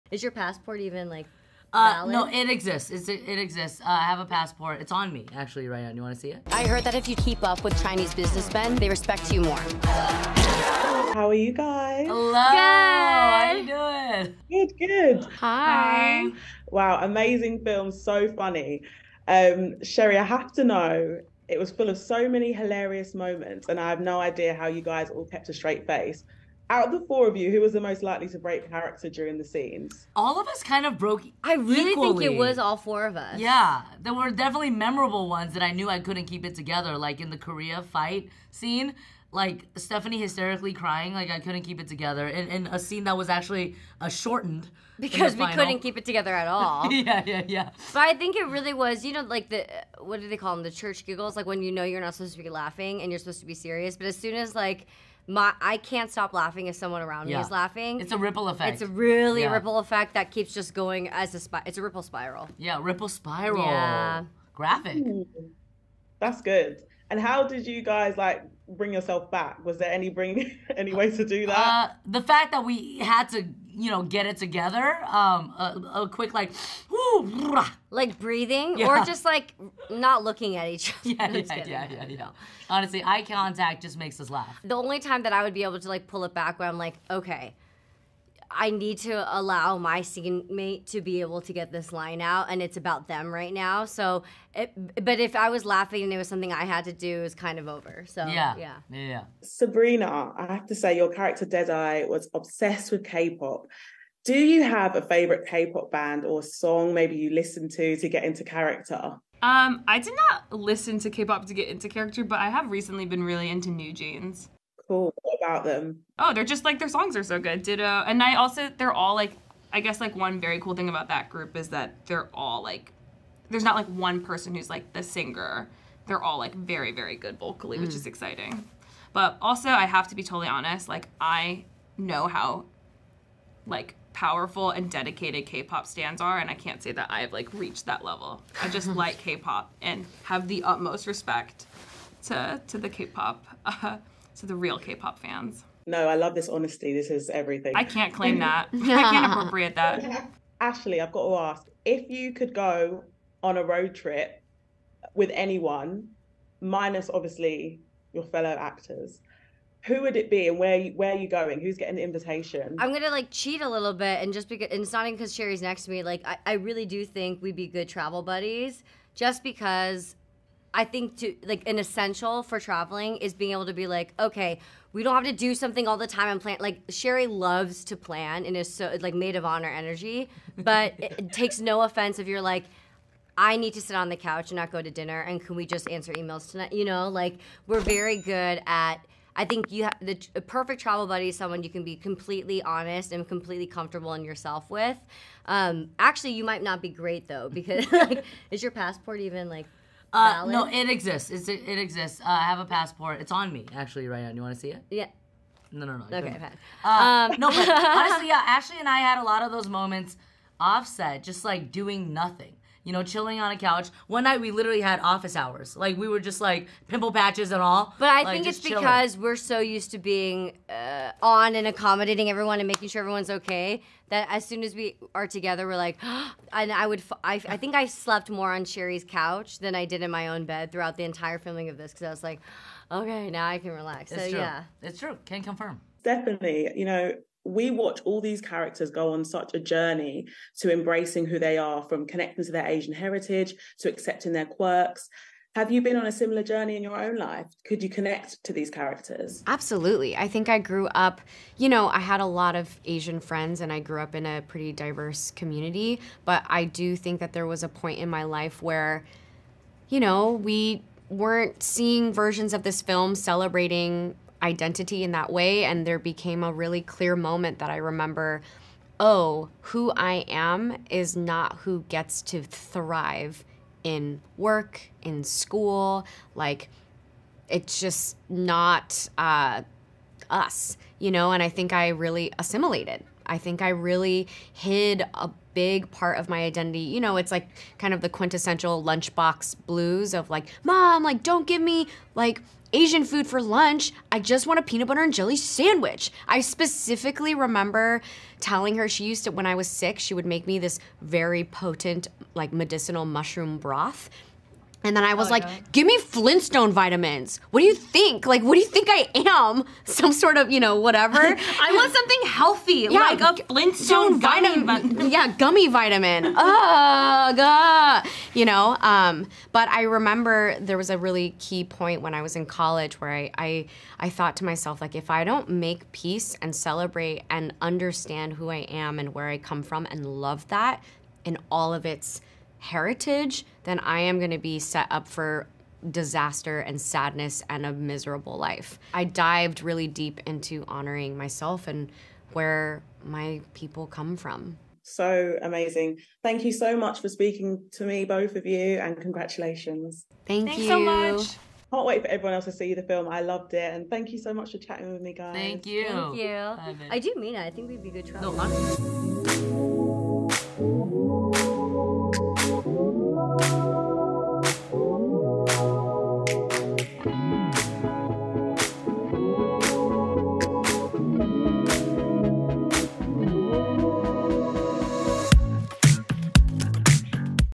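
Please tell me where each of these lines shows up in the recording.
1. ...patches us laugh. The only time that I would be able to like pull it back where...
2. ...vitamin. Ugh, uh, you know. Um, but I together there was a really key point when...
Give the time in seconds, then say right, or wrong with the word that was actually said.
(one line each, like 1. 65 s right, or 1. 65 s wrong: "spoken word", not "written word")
1. 83 s wrong: "makes", not "patches"
2. 315 s wrong: "remember", not "together".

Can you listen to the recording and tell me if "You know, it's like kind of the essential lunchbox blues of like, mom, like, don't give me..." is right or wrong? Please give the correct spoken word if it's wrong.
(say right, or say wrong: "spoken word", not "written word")
wrong: "quintessential", not "essential".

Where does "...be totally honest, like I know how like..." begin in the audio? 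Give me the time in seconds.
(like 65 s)
130 s.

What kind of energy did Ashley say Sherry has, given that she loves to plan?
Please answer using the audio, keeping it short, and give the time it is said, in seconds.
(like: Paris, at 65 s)
maid of honor energy, at 179 s.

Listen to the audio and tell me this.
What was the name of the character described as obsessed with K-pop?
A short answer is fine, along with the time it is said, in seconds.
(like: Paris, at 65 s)
Deadeye, at 101 s.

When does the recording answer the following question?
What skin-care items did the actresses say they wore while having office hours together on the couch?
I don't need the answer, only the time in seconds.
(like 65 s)
216 s.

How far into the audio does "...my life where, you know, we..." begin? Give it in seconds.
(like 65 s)
258 s.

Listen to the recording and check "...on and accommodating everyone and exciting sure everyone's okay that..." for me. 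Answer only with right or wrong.
wrong.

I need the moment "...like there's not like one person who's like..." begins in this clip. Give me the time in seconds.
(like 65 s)
122 s.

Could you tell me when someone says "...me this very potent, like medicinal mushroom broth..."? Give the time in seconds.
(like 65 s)
300 s.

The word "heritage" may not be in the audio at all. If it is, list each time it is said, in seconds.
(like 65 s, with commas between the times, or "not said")
242 s, 332 s.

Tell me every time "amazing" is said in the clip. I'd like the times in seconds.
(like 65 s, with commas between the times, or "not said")
17 s, 345 s.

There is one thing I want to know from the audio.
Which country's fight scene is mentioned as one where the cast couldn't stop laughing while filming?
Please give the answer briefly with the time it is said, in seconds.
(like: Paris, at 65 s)
Korea, at 37 s.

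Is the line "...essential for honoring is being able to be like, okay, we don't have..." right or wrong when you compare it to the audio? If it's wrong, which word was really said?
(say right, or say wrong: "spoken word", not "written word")
wrong: "traveling", not "honoring".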